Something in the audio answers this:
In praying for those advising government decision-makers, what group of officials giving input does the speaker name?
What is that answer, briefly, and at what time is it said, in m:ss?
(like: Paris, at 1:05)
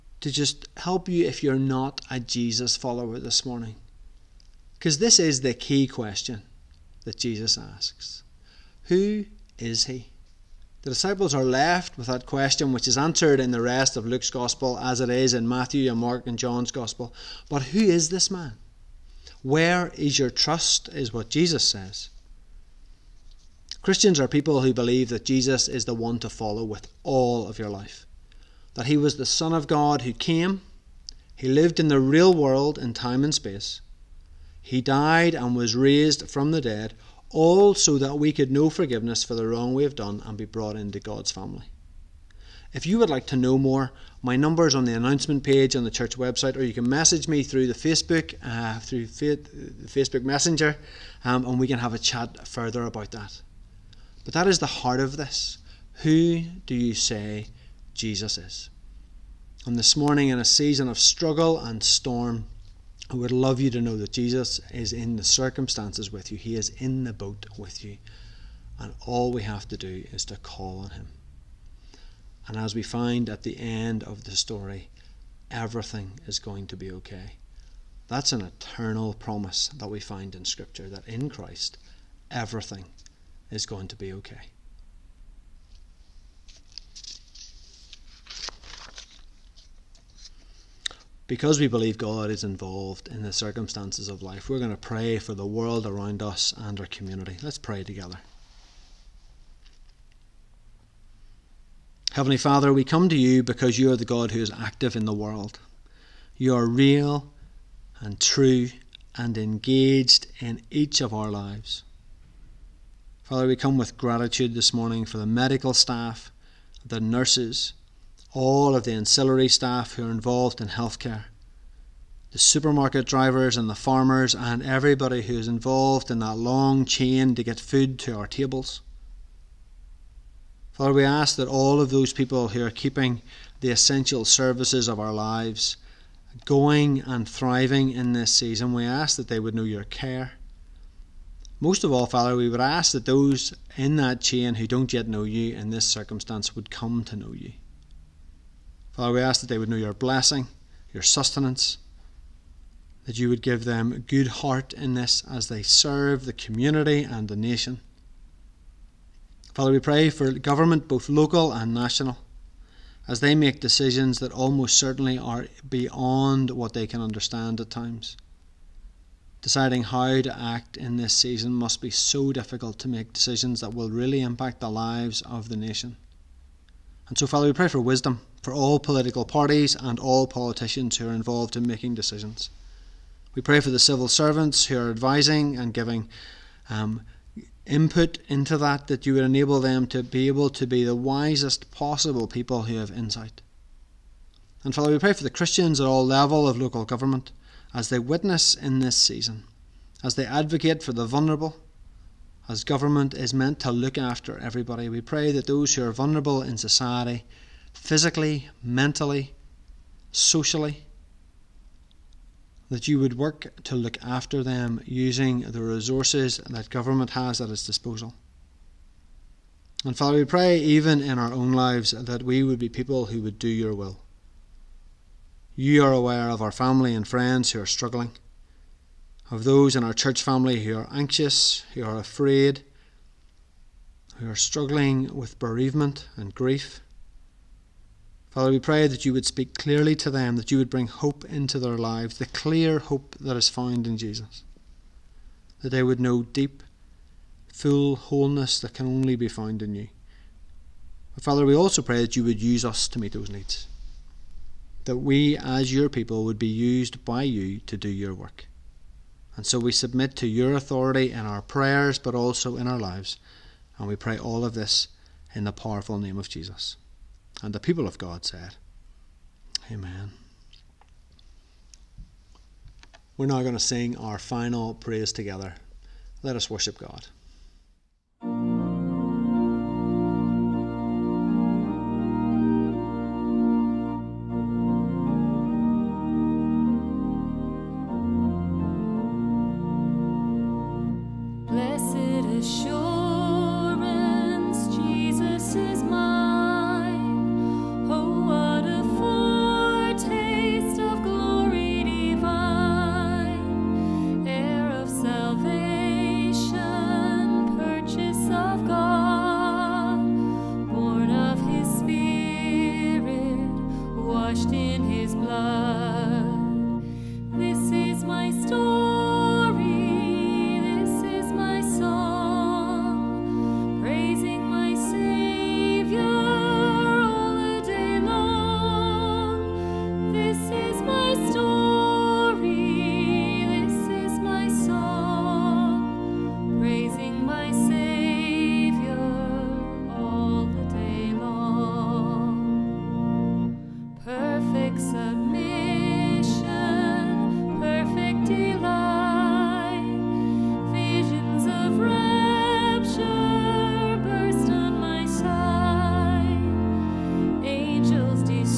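Civil servants, at 3:03.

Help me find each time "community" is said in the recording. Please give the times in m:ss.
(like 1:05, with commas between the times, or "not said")
1:36, 2:36.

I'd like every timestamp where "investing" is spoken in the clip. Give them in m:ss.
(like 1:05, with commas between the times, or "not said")
not said.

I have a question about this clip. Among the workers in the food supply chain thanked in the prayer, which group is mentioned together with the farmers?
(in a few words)
Supermarket drivers.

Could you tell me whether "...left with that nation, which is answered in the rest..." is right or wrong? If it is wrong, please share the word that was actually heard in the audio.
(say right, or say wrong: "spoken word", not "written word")
wrong: "question", not "nation".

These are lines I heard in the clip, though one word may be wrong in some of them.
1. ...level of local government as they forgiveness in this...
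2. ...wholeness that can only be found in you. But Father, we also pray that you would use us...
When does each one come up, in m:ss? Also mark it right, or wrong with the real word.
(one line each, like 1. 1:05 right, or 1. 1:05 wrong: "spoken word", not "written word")
1. 3:16 wrong: "witness", not "forgiveness"
2. 4:07 right.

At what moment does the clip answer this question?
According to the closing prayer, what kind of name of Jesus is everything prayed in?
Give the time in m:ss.
4:25.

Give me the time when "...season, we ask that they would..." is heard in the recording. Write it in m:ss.
2:18.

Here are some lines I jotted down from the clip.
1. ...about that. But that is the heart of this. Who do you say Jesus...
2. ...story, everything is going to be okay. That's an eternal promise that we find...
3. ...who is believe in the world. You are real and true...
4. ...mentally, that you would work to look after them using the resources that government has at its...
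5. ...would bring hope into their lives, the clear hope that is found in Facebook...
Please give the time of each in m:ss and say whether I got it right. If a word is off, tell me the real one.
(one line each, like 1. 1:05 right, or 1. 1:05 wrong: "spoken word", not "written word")
1. 0:52 right
2. 1:14 right
3. 1:44 wrong: "active", not "believe"
4. 3:30 wrong: "socially", not "mentally"
5. 4:00 wrong: "Jesus", not "Facebook".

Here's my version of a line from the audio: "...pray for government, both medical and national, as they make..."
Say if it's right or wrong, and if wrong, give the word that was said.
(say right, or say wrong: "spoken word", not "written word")
wrong: "local", not "medical".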